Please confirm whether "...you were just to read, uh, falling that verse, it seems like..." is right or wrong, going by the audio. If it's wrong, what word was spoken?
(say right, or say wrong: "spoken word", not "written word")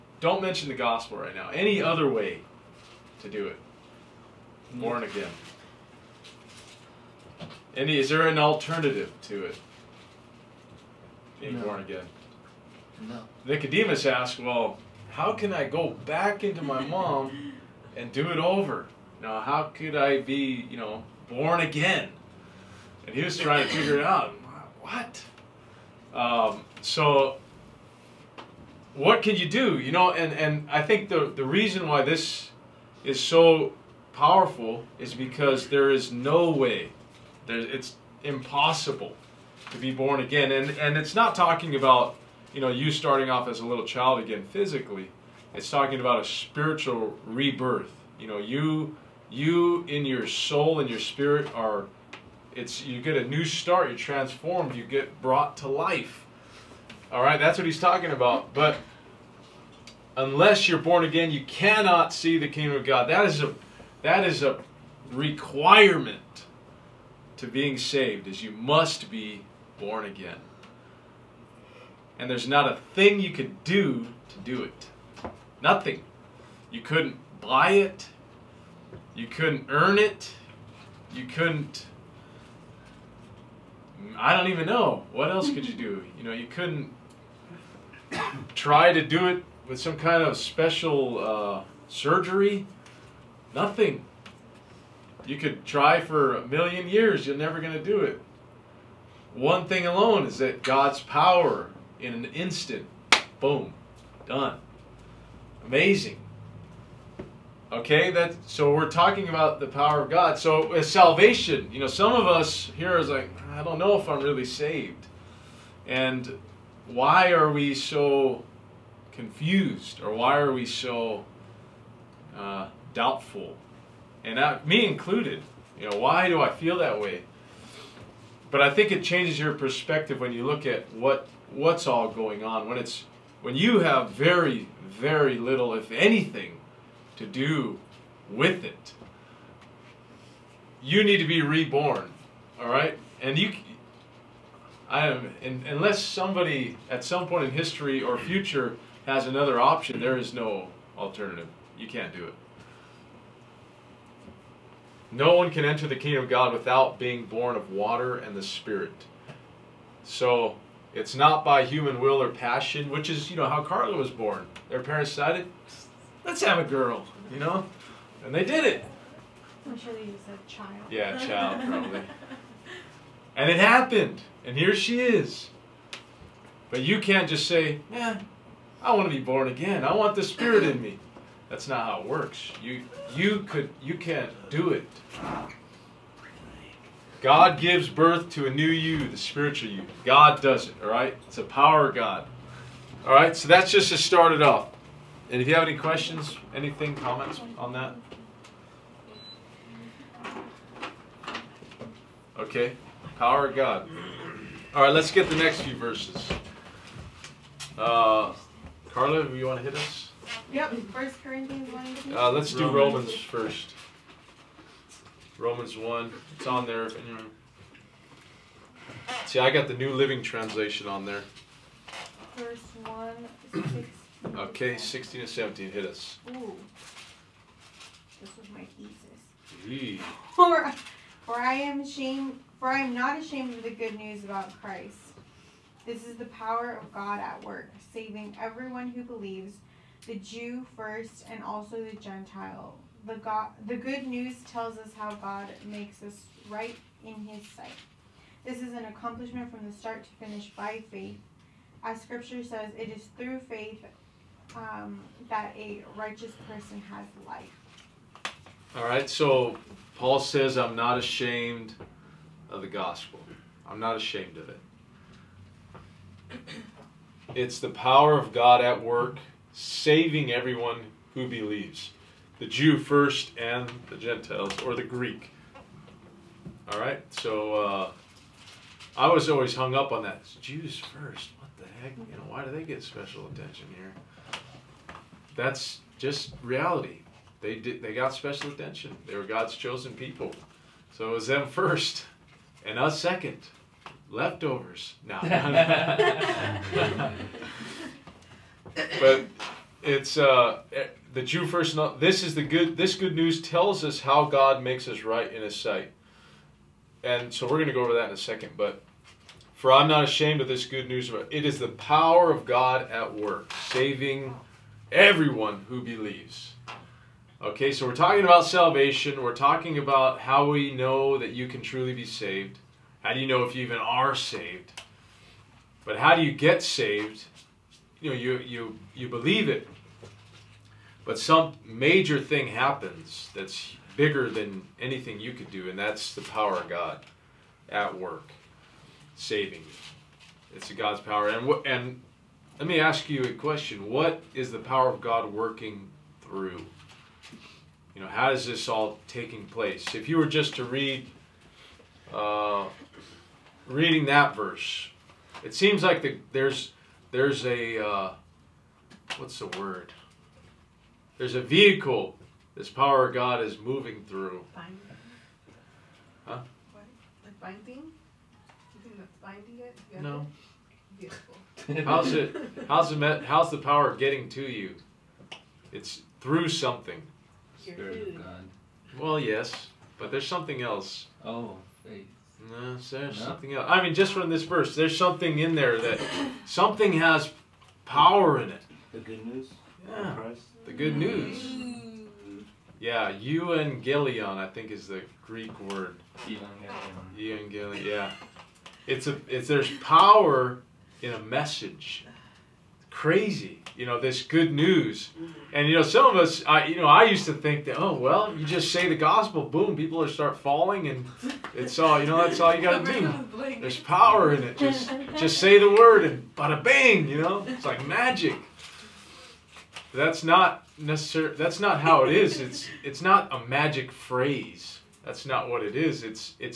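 wrong: "reading", not "falling".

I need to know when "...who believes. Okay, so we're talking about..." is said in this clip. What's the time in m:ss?
5:15.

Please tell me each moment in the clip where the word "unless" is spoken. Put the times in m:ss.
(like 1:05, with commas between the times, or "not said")
1:00, 2:25.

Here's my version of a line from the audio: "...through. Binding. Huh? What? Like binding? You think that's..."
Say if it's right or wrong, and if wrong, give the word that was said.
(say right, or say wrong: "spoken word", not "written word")
right.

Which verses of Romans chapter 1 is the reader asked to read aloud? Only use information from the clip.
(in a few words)
16 and 17.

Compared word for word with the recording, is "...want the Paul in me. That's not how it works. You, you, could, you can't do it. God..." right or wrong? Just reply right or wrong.
wrong.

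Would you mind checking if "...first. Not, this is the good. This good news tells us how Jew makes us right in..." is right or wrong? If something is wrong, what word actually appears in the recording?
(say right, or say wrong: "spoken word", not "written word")
wrong: "God", not "Jew".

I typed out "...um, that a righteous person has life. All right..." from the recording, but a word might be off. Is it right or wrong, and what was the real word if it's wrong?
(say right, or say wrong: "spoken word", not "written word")
right.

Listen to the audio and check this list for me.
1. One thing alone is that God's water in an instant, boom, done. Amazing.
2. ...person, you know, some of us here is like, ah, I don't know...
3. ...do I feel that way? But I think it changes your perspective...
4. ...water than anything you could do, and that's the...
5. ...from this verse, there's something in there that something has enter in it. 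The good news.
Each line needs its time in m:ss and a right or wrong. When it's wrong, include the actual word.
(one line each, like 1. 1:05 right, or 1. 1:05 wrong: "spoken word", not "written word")
1. 1:39 wrong: "power", not "water"
2. 1:50 wrong: "salvation", not "person"
3. 2:06 right
4. 5:33 wrong: "bigger", not "water"
5. 6:24 wrong: "power", not "enter".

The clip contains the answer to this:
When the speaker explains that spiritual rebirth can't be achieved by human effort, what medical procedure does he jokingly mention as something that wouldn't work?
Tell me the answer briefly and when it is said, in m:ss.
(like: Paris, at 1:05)
Surgery, at 1:31.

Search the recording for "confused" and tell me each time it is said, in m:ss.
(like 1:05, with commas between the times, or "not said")
1:59.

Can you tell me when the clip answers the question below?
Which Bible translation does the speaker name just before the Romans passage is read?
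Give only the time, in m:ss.
3:39.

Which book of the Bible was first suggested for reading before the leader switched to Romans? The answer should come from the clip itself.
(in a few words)
First Corinthians.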